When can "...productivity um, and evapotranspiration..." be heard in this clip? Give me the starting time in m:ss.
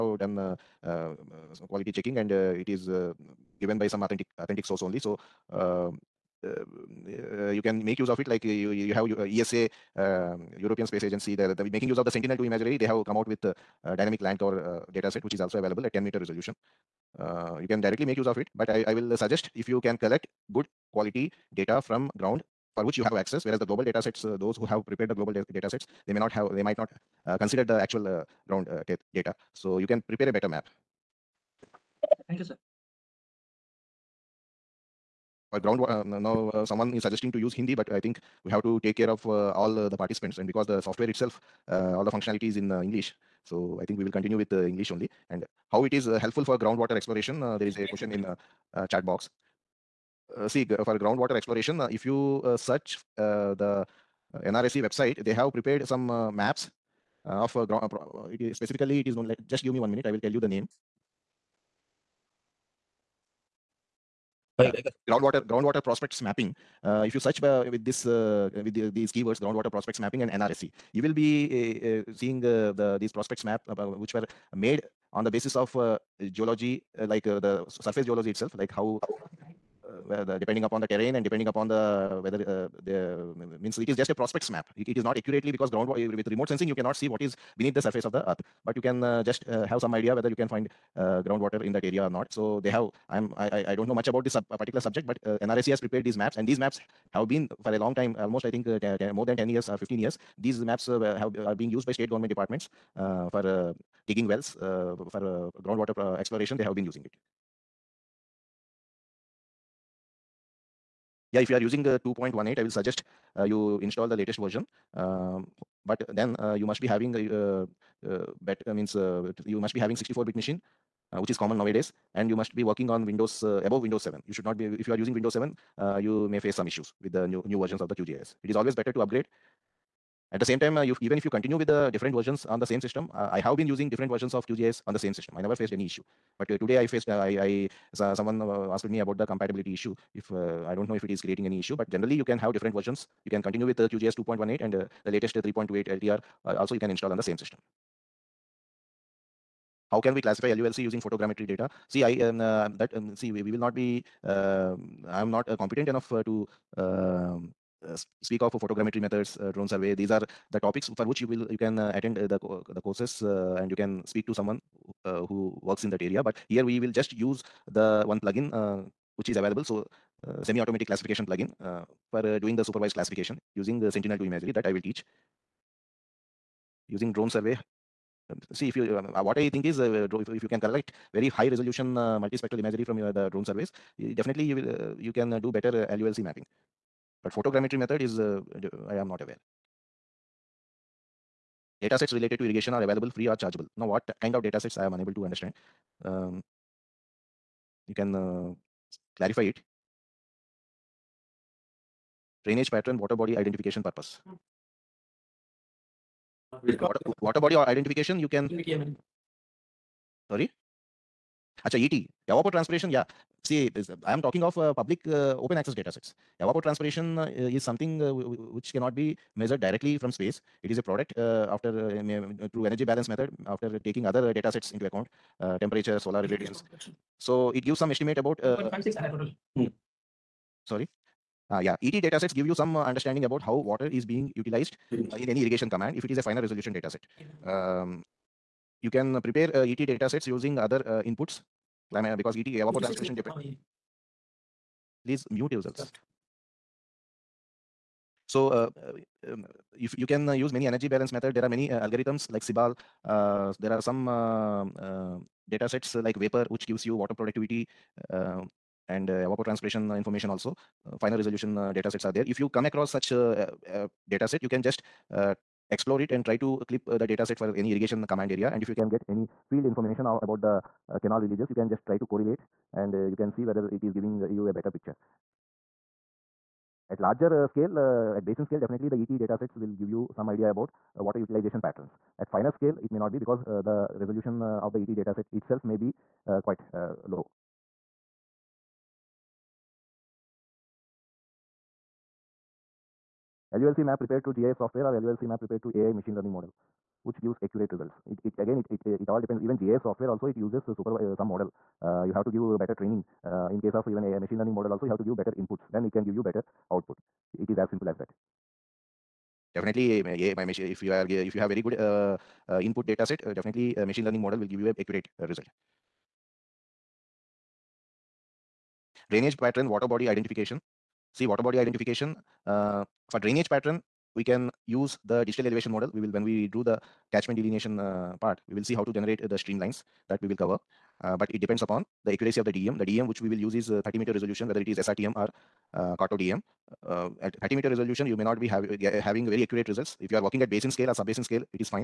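4:17.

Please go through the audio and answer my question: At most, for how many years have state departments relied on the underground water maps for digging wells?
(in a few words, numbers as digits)
15.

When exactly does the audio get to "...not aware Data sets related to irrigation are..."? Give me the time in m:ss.
3:09.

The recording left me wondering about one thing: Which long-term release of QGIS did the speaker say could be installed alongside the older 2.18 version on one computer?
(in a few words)
3.28 LTR.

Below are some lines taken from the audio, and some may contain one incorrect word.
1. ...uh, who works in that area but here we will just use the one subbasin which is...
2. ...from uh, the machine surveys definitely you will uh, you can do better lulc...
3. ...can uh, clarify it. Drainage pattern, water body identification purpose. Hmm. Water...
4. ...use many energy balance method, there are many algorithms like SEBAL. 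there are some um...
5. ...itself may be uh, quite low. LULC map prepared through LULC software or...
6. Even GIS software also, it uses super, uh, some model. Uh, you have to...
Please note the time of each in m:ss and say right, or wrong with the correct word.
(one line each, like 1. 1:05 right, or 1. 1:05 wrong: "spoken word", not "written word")
1. 2:45 wrong: "plugin", not "subbasin"
2. 3:02 wrong: "drone", not "machine"
3. 3:17 right
4. 4:10 right
5. 4:45 wrong: "GIS", not "LULC"
6. 4:59 right.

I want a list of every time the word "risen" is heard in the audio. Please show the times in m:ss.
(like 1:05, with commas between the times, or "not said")
not said.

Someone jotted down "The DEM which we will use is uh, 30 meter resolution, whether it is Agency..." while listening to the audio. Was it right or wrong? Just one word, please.
wrong.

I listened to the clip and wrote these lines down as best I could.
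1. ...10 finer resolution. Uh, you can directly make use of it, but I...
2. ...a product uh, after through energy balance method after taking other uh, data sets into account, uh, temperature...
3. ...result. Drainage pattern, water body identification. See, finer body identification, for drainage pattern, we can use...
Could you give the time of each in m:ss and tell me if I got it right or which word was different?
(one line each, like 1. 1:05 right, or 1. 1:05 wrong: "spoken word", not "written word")
1. 0:15 wrong: "meter", not "finer"
2. 3:40 right
3. 5:15 wrong: "water", not "finer".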